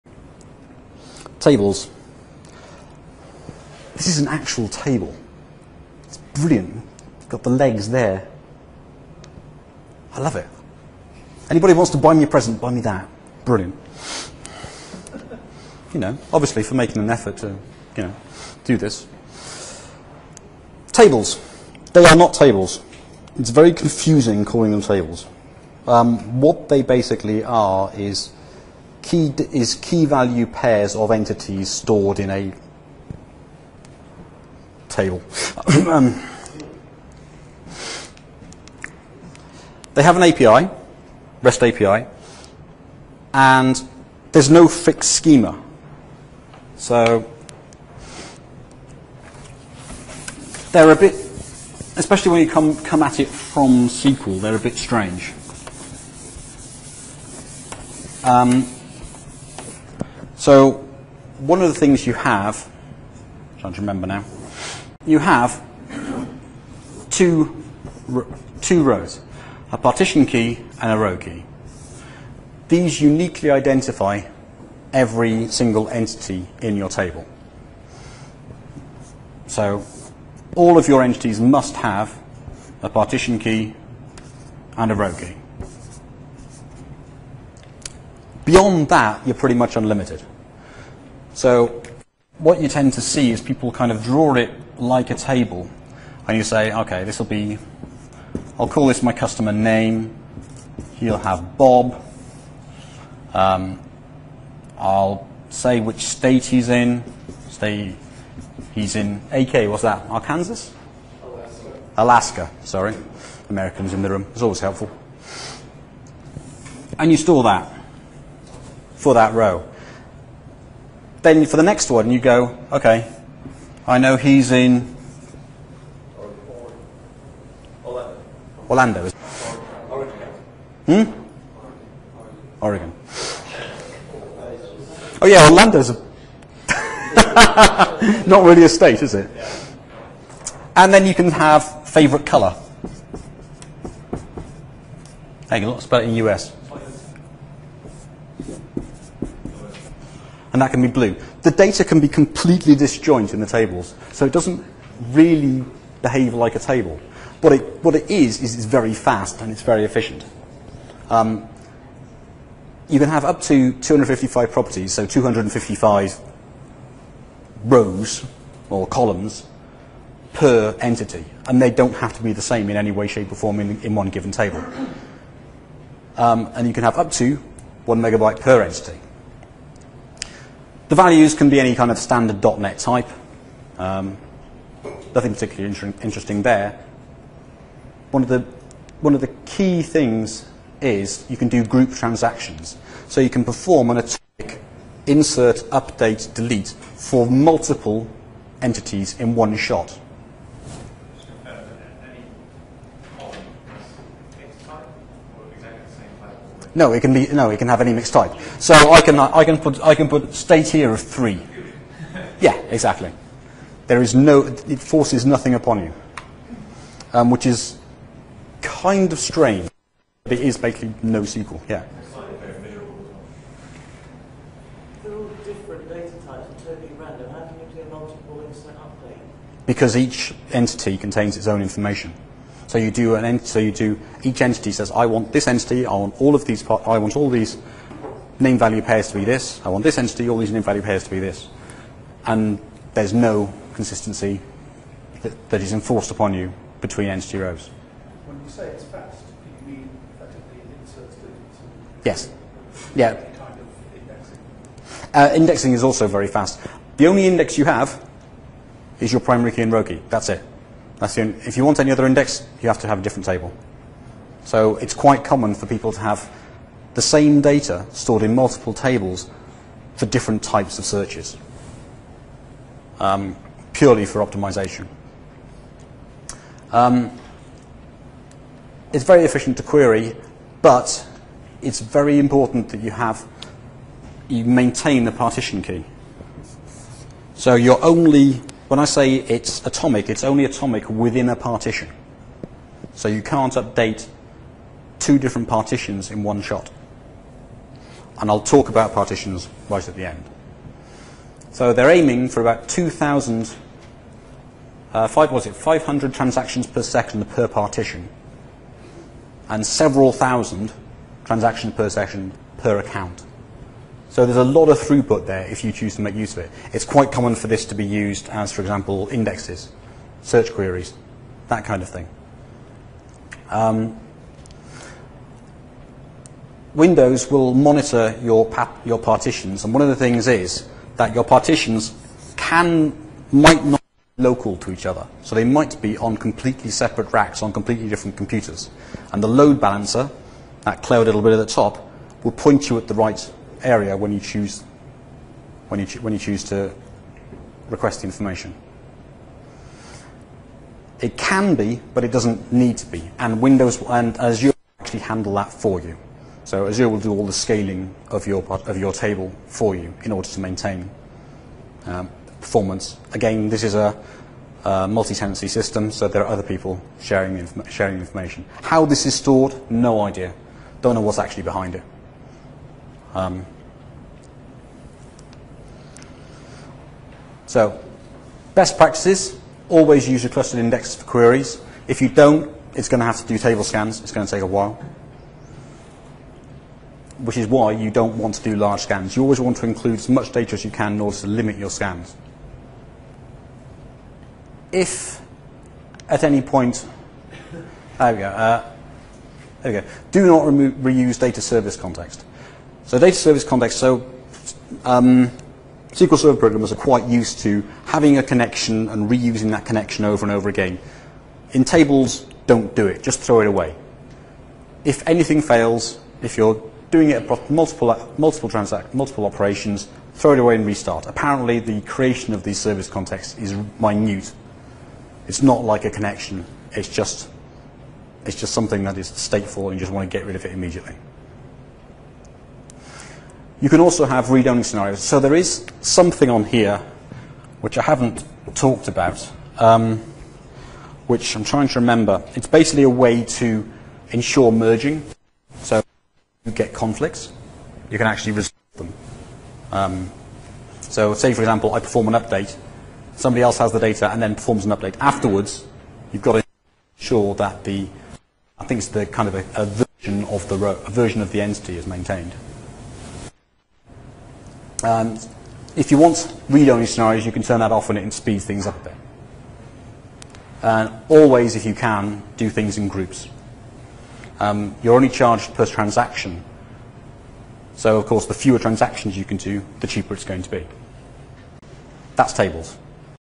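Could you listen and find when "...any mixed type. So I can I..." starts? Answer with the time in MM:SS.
03:27.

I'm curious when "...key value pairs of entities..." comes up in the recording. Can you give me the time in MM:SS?
00:29.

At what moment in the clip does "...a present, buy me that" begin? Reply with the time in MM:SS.
00:12.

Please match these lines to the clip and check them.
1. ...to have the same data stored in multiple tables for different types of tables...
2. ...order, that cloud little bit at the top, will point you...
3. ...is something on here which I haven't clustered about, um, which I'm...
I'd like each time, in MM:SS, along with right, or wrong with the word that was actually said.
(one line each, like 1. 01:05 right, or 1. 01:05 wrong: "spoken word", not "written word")
1. 04:25 wrong: "searches", not "tables"
2. 05:39 wrong: "balancer", not "order"
3. 07:15 wrong: "talked", not "clustered".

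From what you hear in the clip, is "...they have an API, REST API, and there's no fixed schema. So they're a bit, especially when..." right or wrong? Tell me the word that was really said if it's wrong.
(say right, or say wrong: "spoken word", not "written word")
right.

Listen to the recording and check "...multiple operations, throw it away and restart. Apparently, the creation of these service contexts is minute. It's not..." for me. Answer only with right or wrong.
right.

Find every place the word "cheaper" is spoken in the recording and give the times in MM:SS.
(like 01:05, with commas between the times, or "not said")
07:59.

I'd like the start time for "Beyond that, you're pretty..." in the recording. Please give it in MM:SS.
01:28.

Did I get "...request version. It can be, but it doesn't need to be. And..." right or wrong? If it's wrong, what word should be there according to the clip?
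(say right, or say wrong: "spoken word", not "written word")
wrong: "information", not "version".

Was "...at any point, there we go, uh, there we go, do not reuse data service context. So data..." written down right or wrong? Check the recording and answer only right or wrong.
right.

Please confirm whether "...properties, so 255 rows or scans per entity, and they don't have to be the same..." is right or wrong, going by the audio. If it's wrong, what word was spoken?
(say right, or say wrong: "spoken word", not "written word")
wrong: "columns", not "scans".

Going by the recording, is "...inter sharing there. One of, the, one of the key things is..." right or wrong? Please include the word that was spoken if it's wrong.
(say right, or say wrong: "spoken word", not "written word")
wrong: "interesting", not "sharing".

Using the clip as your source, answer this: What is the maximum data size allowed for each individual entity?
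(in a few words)
one megabyte.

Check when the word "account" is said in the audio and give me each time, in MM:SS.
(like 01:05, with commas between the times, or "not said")
05:12.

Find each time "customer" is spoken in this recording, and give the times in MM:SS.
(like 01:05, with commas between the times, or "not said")
01:39.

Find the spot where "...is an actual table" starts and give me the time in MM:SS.
00:04.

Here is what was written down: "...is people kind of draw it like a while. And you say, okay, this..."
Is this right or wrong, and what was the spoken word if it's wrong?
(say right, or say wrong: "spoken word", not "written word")
wrong: "table", not "while".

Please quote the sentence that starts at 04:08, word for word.
When you say it's fast, do you mean effectively it inserts Yes.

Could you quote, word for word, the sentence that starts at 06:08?
How this is stored, no idea.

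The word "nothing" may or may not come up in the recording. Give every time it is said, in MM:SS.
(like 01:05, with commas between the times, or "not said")
03:05, 03:35.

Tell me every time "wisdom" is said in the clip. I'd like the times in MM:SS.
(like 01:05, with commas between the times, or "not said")
not said.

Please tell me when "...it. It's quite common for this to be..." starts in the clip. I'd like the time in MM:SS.
05:16.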